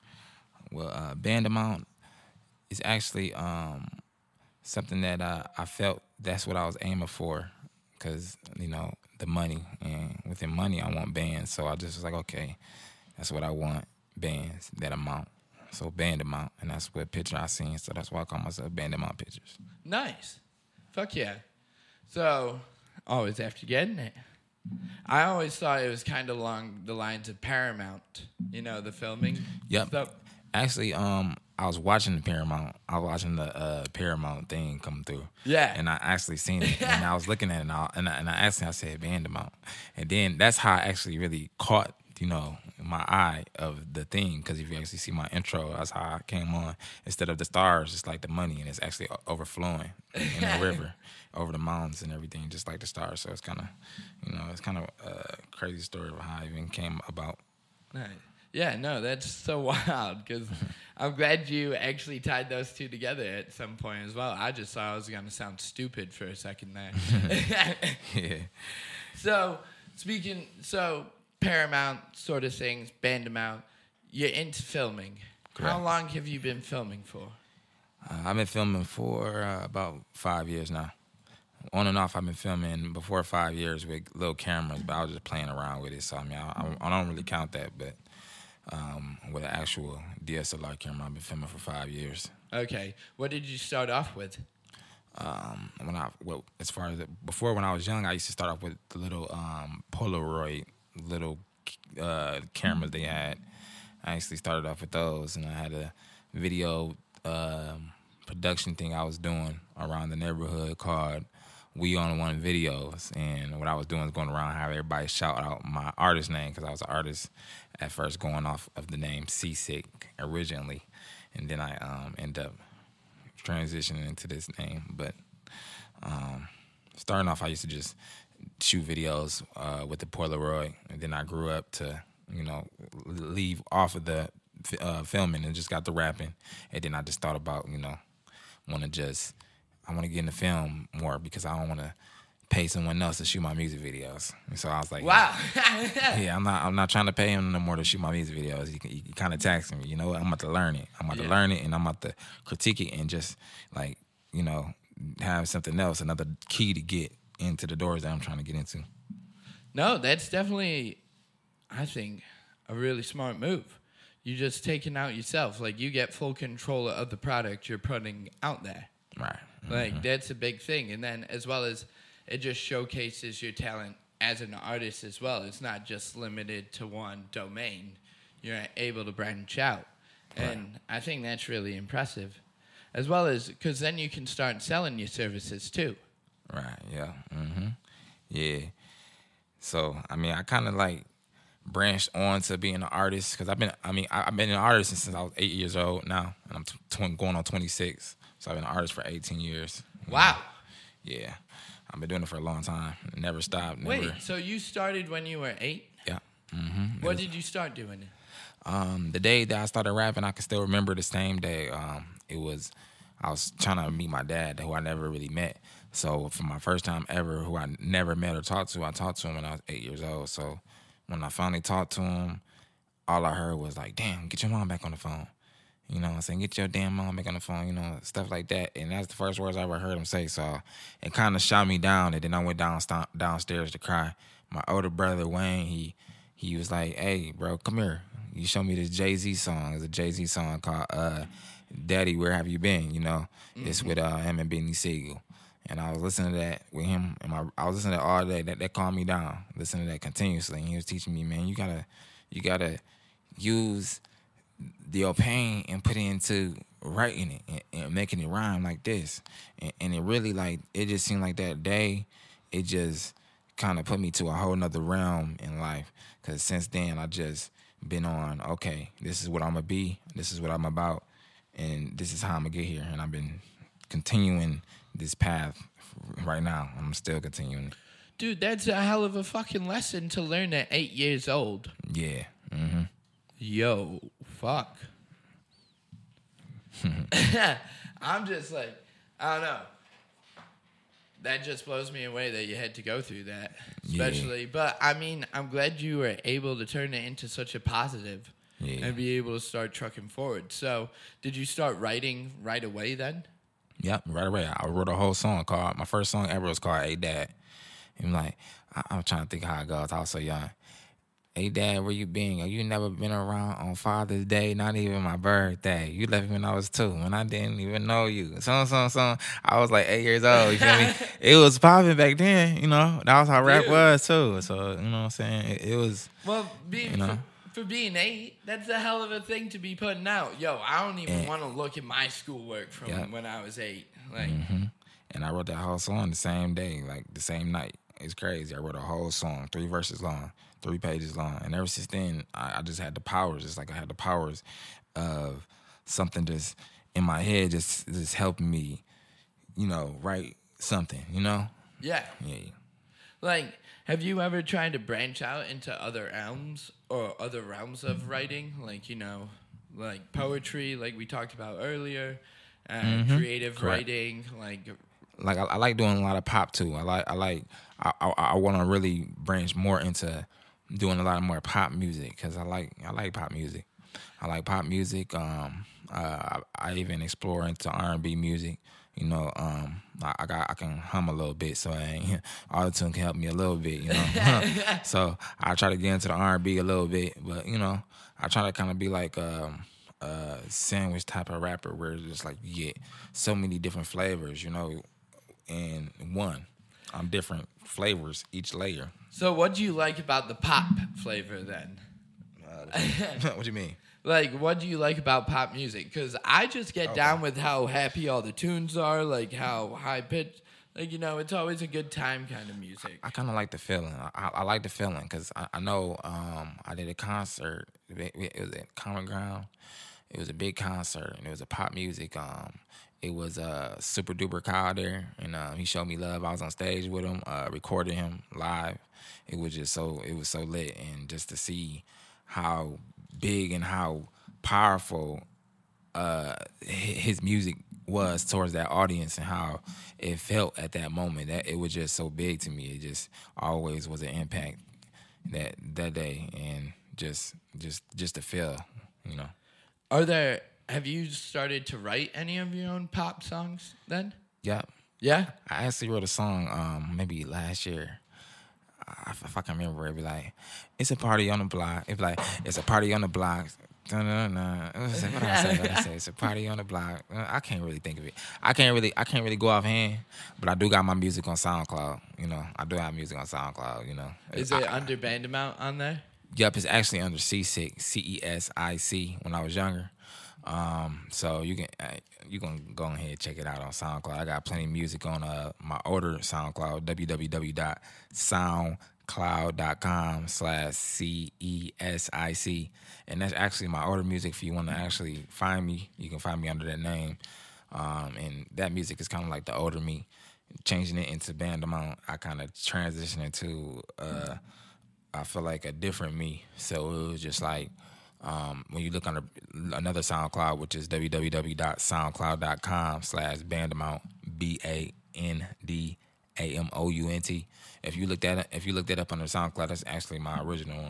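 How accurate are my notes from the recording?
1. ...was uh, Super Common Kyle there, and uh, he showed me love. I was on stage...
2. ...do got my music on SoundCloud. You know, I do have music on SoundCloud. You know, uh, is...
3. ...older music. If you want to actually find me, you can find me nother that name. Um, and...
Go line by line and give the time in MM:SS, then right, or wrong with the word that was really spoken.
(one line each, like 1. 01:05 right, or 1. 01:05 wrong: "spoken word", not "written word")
1. 07:03 wrong: "Duper", not "Common"
2. 07:50 right
3. 08:13 wrong: "under", not "nother".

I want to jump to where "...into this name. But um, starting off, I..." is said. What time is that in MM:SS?
02:04.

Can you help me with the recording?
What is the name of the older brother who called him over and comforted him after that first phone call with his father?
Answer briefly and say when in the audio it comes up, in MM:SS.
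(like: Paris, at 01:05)
Wayne, at 03:55.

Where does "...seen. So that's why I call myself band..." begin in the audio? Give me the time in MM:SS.
00:17.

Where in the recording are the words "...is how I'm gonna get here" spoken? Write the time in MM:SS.
04:32.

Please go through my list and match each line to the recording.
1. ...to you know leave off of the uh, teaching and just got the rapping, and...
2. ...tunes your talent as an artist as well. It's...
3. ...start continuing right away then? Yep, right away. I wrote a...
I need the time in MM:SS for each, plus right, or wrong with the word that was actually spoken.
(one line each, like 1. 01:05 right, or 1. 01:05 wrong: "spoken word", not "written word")
1. 02:11 wrong: "filming", not "teaching"
2. 02:52 wrong: "showcases", not "tunes"
3. 05:01 wrong: "writing", not "continuing".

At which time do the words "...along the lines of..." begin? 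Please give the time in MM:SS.
00:26.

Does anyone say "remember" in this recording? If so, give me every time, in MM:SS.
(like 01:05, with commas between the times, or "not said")
03:30, 07:39.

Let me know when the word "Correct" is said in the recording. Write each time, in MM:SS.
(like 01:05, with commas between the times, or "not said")
01:15, 06:03.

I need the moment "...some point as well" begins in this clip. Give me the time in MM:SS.
01:03.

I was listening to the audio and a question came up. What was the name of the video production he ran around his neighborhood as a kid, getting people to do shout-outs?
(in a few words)
We On One Videos.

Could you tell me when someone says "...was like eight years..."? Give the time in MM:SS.
05:19.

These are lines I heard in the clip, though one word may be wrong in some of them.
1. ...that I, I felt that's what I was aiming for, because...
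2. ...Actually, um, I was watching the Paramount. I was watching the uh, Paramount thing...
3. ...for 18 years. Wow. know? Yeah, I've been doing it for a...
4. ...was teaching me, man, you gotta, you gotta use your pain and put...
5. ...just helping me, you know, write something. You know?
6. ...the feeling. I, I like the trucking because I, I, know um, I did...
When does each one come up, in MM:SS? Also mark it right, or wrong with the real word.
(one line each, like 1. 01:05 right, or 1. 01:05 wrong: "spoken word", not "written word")
1. 00:05 right
2. 00:30 right
3. 03:18 right
4. 04:10 right
5. 05:47 right
6. 06:53 wrong: "feeling", not "trucking".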